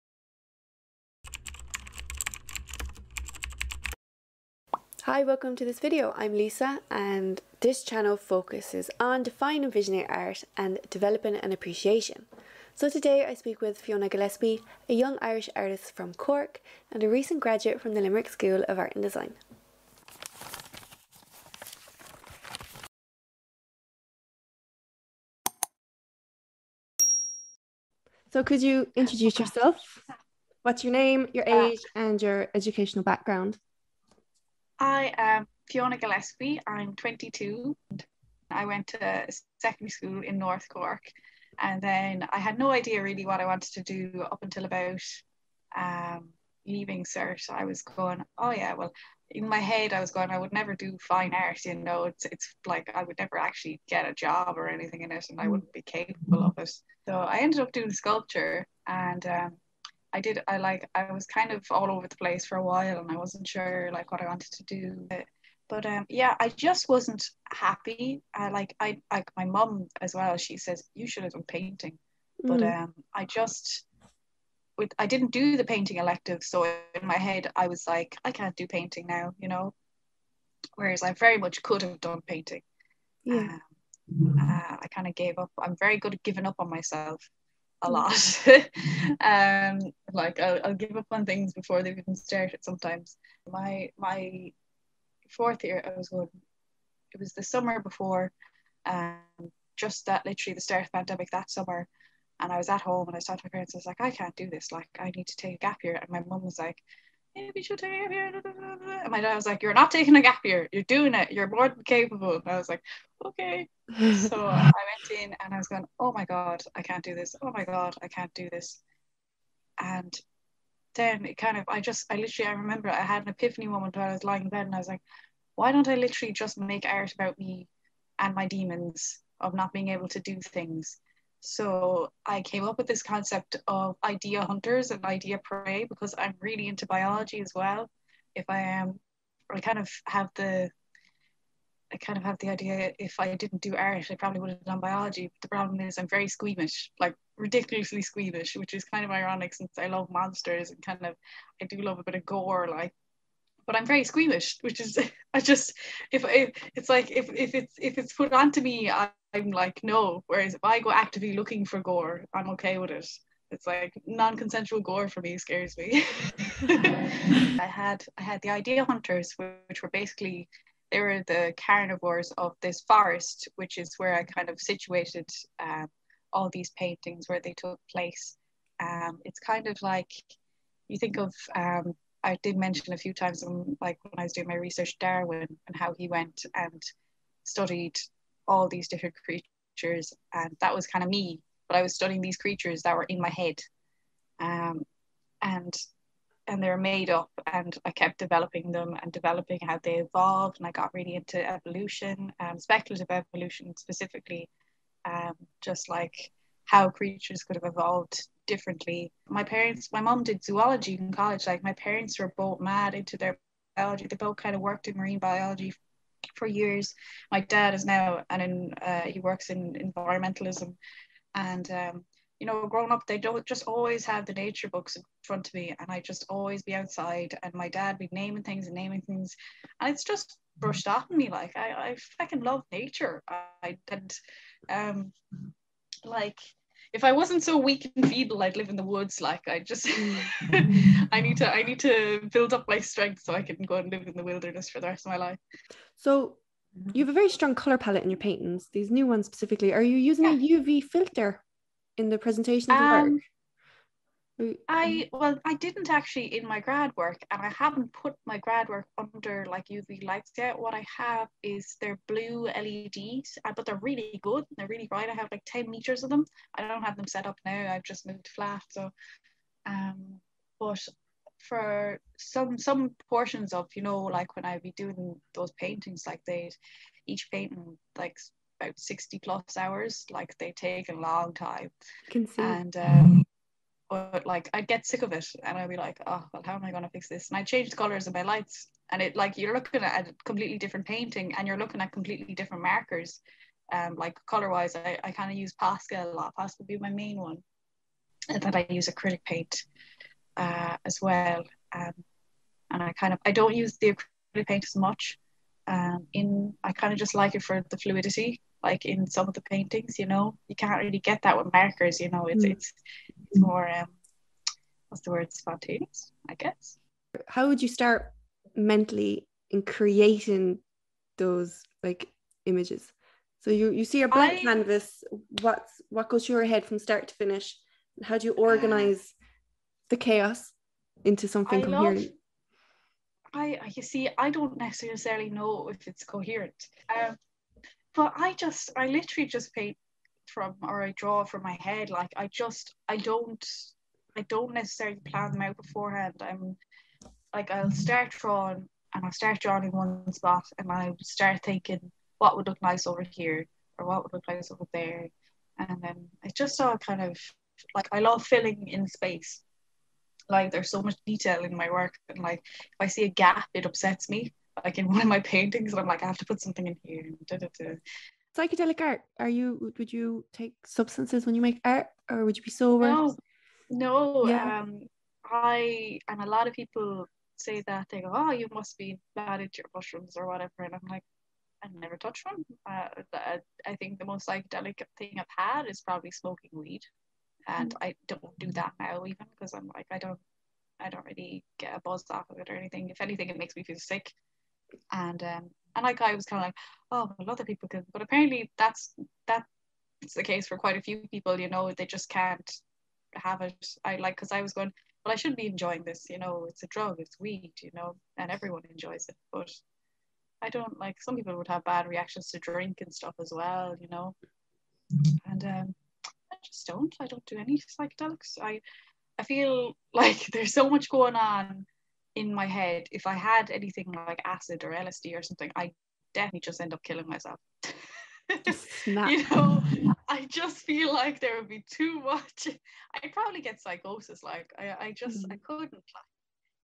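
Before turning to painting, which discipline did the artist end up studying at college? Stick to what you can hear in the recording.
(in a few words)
Sculpture.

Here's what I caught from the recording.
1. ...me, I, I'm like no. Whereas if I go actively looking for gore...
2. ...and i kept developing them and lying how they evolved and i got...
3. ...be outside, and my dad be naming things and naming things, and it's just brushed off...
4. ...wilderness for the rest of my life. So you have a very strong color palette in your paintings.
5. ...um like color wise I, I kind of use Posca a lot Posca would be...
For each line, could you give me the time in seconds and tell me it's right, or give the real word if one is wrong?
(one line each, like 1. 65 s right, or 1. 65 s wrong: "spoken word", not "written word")
1. 158 s right
2. 197 s wrong: "developing", not "lying"
3. 226 s right
4. 244 s right
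5. 293 s right.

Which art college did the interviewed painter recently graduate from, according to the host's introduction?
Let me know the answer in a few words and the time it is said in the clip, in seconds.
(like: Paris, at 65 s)
Limerick School of Art and Design, at 18 s.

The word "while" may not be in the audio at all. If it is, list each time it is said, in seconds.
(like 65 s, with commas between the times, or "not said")
62 s, 123 s.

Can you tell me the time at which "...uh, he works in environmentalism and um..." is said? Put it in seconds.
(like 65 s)
218 s.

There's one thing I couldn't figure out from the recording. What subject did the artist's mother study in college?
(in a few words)
Zoology.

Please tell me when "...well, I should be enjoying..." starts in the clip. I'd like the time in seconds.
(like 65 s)
405 s.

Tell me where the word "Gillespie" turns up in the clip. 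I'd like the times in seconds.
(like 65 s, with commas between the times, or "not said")
14 s, 35 s.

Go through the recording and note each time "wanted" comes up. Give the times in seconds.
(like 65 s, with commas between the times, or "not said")
43 s, 64 s.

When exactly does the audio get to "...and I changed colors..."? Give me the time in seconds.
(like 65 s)
287 s.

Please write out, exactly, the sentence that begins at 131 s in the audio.
So I came up with this concept of idea hunters and idea prey because I'm really into biology as well.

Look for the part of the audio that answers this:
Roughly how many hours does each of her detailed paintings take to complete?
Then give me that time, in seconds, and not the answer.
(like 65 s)
278 s.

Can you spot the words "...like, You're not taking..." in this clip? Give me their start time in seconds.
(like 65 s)
109 s.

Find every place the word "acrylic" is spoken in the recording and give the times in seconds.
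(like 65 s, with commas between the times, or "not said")
298 s, 304 s.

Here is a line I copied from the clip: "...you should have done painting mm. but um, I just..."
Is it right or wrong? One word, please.
right.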